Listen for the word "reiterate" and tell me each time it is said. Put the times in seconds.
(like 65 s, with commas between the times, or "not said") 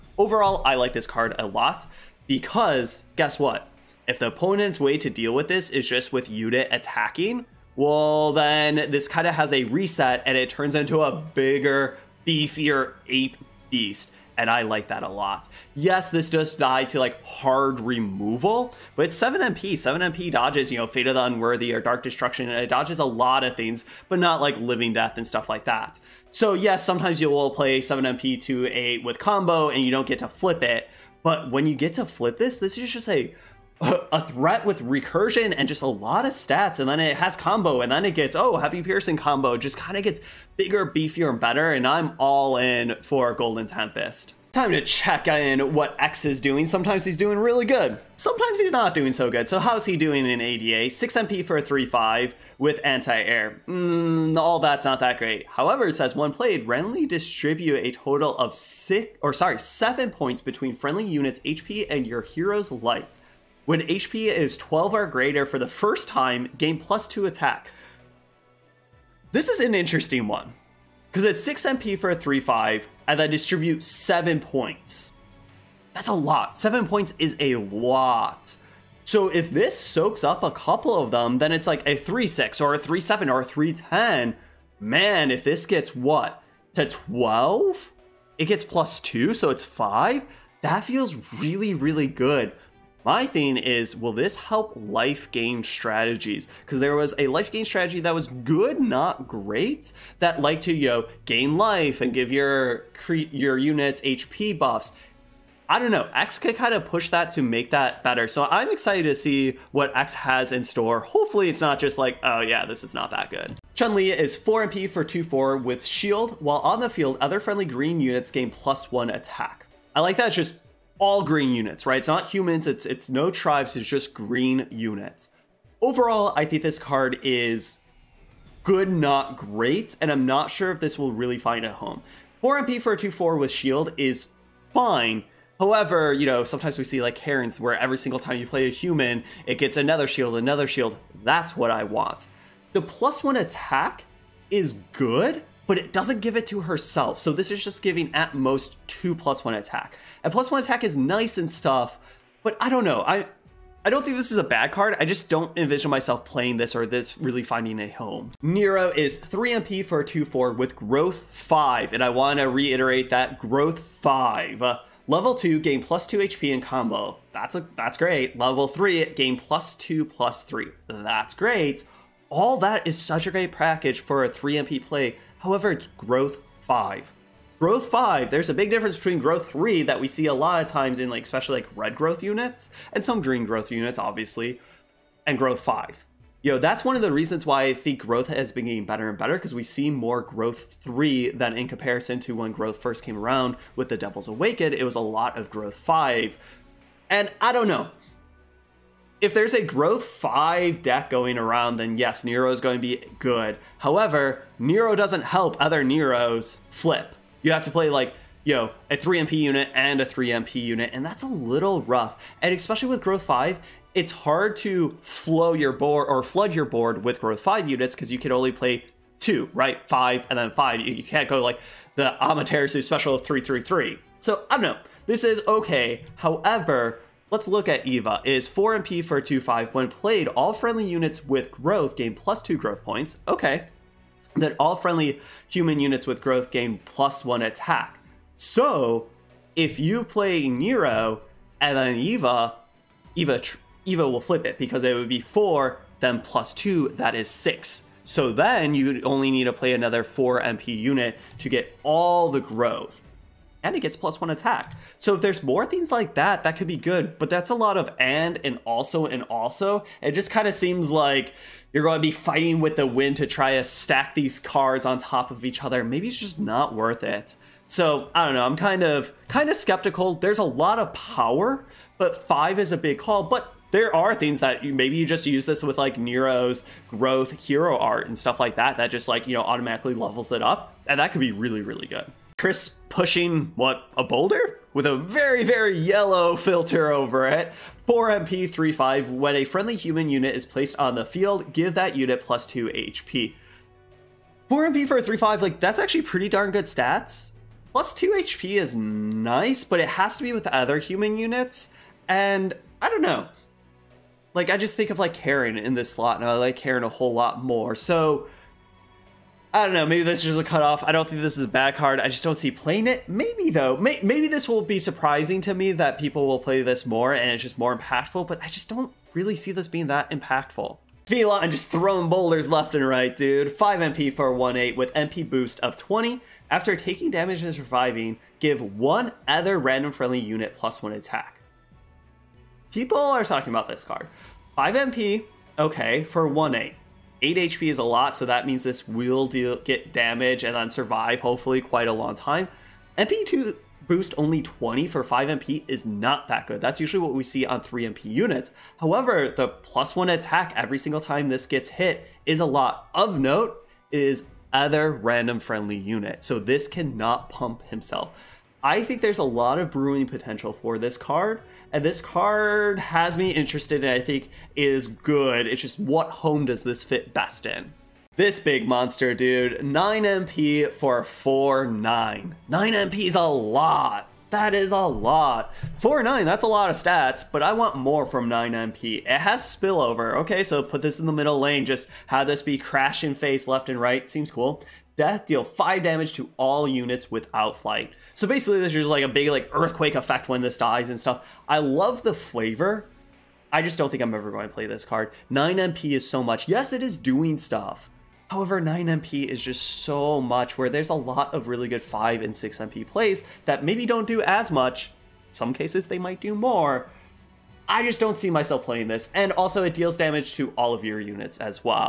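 162 s.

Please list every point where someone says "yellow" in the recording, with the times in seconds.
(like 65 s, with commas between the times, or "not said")
285 s.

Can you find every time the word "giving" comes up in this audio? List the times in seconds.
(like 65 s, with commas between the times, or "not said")
147 s.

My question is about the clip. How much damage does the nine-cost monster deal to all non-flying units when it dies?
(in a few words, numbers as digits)
5.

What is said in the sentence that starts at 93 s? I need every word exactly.
My thing is, will this help life gain strategies?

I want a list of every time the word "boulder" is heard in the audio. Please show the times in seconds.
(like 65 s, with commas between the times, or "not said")
284 s, 322 s.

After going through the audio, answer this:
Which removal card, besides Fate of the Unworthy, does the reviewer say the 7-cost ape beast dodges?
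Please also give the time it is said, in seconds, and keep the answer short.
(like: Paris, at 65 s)
Dark Destruction, at 21 s.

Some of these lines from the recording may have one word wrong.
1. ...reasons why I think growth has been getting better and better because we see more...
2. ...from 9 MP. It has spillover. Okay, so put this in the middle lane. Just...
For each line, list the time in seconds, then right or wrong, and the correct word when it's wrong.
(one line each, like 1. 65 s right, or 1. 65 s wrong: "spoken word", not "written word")
1. 187 s right
2. 378 s right.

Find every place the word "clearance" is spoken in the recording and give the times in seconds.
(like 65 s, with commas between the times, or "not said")
not said.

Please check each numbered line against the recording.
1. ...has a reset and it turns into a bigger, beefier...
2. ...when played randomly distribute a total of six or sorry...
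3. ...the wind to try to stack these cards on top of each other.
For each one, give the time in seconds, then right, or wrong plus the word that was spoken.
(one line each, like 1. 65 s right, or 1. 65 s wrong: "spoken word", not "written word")
1. 9 s right
2. 56 s right
3. 262 s right.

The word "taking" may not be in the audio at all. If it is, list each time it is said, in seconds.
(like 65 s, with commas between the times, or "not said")
326 s.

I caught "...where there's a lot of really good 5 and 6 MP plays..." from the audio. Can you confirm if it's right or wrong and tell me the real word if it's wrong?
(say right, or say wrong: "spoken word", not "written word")
right.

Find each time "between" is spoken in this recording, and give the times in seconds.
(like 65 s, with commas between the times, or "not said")
60 s, 178 s.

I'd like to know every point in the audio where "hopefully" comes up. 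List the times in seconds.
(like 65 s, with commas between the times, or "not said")
111 s, 341 s.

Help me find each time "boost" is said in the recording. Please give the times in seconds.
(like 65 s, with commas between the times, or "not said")
325 s, 343 s.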